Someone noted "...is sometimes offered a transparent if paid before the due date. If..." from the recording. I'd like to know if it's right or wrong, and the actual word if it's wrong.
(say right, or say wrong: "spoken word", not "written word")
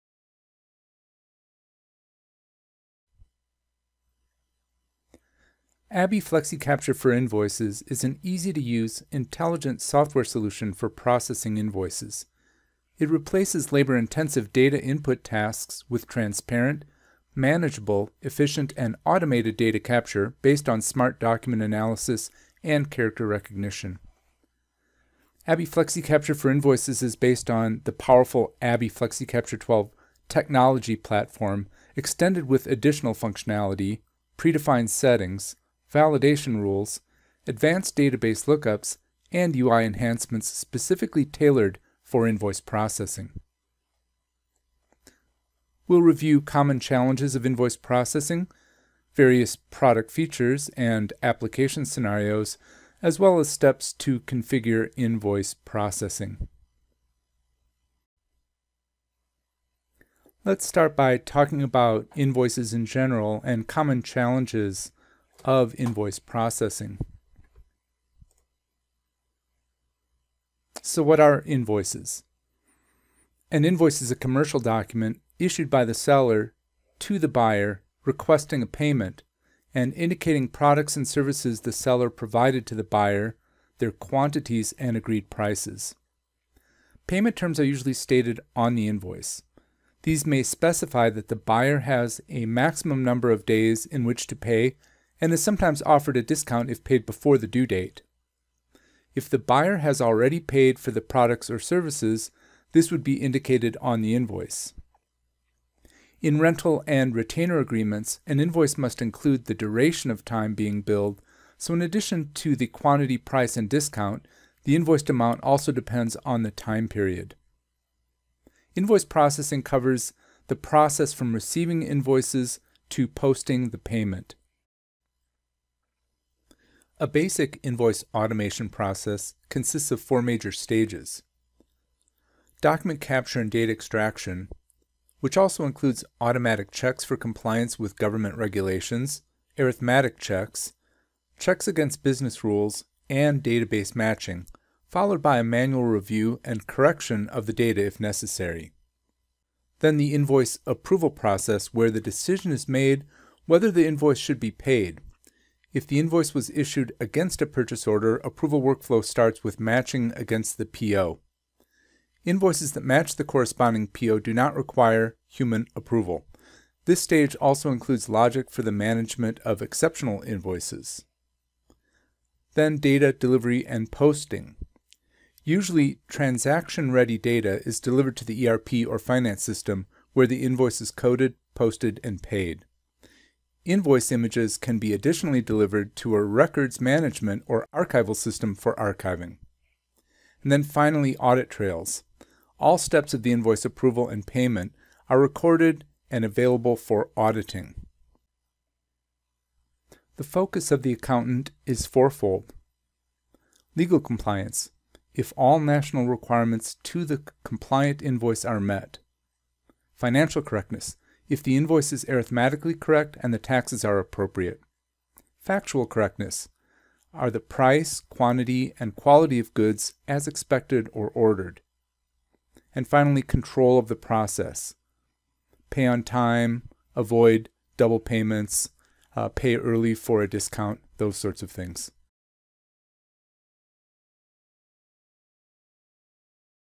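wrong: "discount", not "transparent".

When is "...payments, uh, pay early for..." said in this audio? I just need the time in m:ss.
3:48.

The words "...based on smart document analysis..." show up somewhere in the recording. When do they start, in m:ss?
0:20.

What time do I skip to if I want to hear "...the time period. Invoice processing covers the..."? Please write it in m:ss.
1:56.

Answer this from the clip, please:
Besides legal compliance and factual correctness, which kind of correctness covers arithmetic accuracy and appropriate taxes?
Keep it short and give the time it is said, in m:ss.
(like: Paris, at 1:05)
Financial correctness, at 3:29.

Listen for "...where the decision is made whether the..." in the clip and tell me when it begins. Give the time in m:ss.
2:31.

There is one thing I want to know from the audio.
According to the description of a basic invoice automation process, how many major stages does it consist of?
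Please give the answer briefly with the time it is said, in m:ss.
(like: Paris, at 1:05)
4, at 2:09.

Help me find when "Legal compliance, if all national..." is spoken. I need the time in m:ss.
3:23.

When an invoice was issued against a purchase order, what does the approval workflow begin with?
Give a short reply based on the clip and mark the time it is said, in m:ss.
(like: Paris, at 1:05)
matching against the PO, at 2:39.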